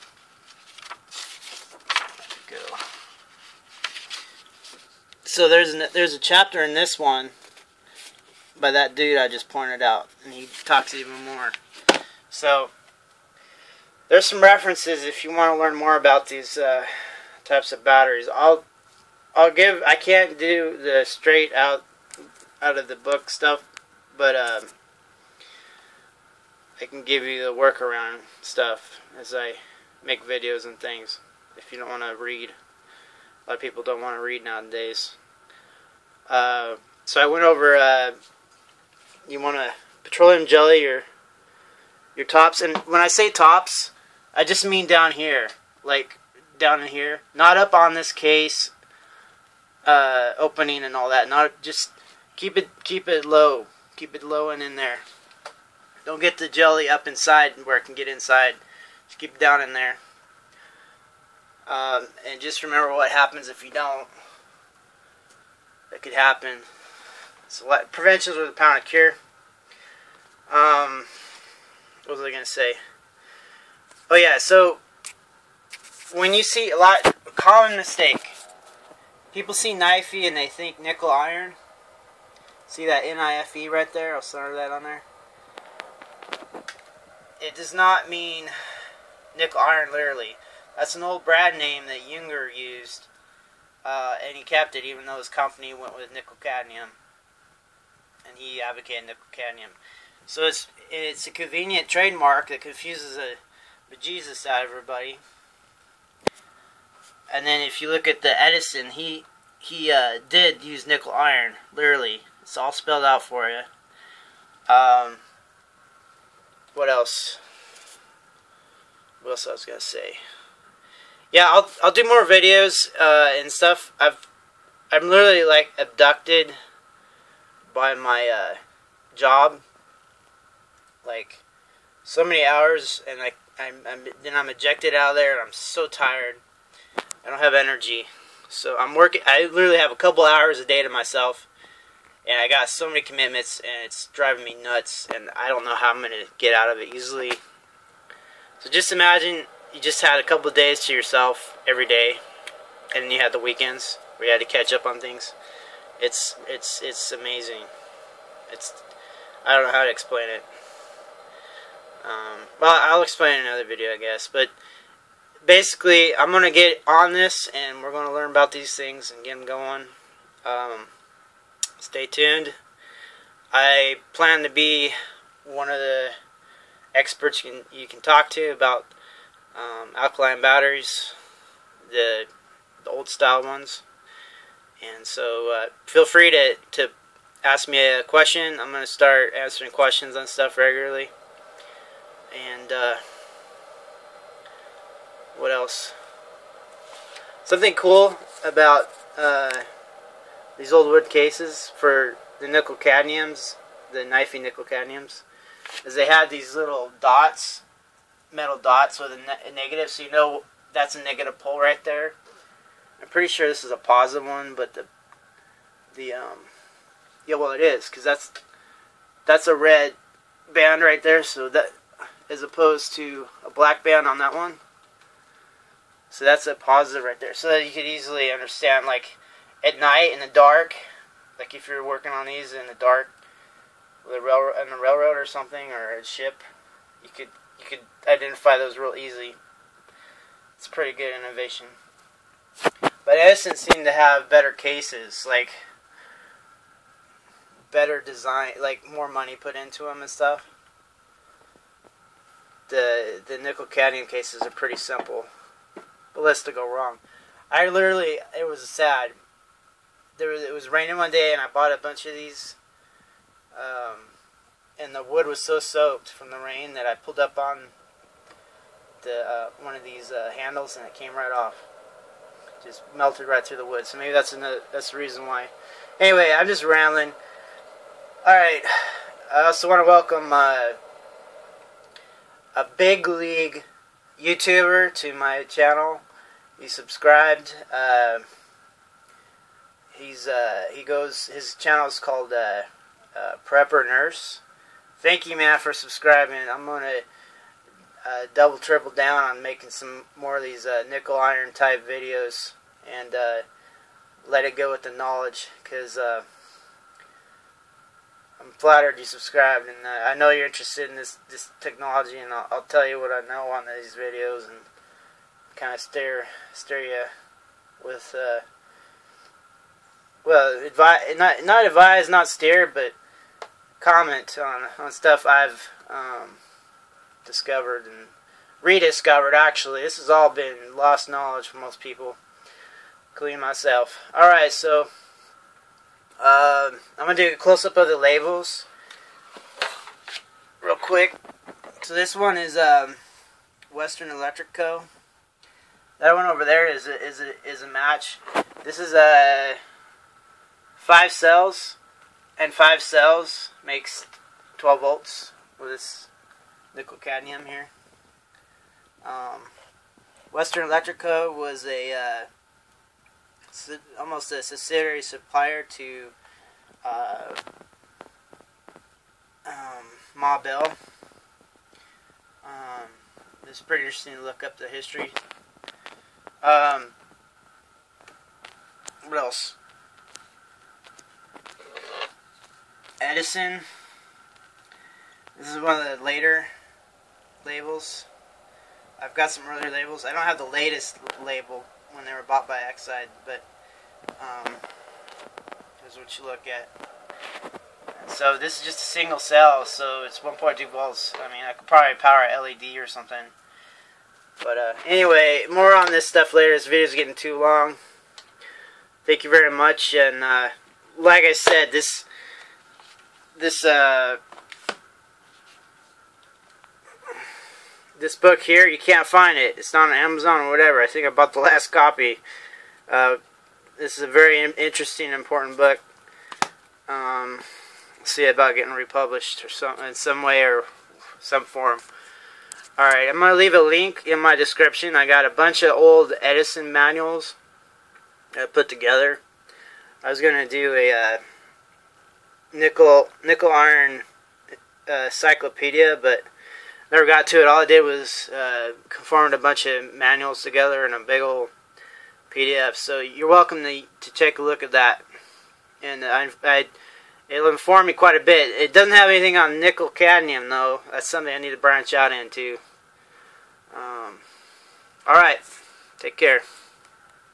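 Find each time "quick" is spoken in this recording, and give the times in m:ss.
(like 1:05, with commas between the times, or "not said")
5:40.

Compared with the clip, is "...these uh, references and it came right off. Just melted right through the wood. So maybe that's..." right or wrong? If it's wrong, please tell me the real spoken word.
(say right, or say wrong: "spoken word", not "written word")
wrong: "handles", not "references".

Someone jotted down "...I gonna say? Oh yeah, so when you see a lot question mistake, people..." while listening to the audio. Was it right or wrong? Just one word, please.
wrong.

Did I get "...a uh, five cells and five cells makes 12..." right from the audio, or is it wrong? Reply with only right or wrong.
right.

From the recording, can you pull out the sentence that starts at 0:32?
A lot of people don't want to read nowadays.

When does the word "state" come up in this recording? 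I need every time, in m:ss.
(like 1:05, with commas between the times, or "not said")
not said.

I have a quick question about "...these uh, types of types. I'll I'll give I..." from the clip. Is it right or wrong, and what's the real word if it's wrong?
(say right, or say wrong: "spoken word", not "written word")
wrong: "batteries", not "types".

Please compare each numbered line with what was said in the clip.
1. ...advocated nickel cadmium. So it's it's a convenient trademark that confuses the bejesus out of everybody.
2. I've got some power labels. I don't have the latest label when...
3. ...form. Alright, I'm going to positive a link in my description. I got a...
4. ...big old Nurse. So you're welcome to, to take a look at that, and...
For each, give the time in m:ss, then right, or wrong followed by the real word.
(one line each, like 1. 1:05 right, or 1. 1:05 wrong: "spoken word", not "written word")
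1. 1:38 right
2. 6:29 wrong: "earlier", not "power"
3. 7:11 wrong: "leave", not "positive"
4. 7:30 wrong: "PDF", not "Nurse".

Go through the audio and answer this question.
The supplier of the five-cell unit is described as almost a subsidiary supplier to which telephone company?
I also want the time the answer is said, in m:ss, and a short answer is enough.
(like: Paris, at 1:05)
Ma Bell, at 6:10.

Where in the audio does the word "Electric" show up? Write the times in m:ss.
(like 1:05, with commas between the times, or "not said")
5:44, 6:00.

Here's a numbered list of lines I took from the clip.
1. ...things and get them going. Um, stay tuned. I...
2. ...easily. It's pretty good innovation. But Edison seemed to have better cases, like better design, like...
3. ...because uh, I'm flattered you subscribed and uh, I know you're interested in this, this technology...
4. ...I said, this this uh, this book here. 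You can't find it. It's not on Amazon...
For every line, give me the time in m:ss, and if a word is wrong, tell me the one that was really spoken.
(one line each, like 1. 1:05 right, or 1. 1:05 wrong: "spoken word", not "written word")
1. 2:48 right
2. 3:58 right
3. 5:05 right
4. 6:51 right.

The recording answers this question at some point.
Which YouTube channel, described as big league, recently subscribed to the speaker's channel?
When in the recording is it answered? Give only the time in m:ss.
4:53.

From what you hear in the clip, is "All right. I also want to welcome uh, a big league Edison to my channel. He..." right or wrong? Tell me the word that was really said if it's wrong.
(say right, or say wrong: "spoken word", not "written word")
wrong: "YouTuber", not "Edison".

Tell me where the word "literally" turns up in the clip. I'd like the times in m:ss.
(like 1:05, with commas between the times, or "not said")
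1:29, 1:51, 2:05, 2:19, 4:17.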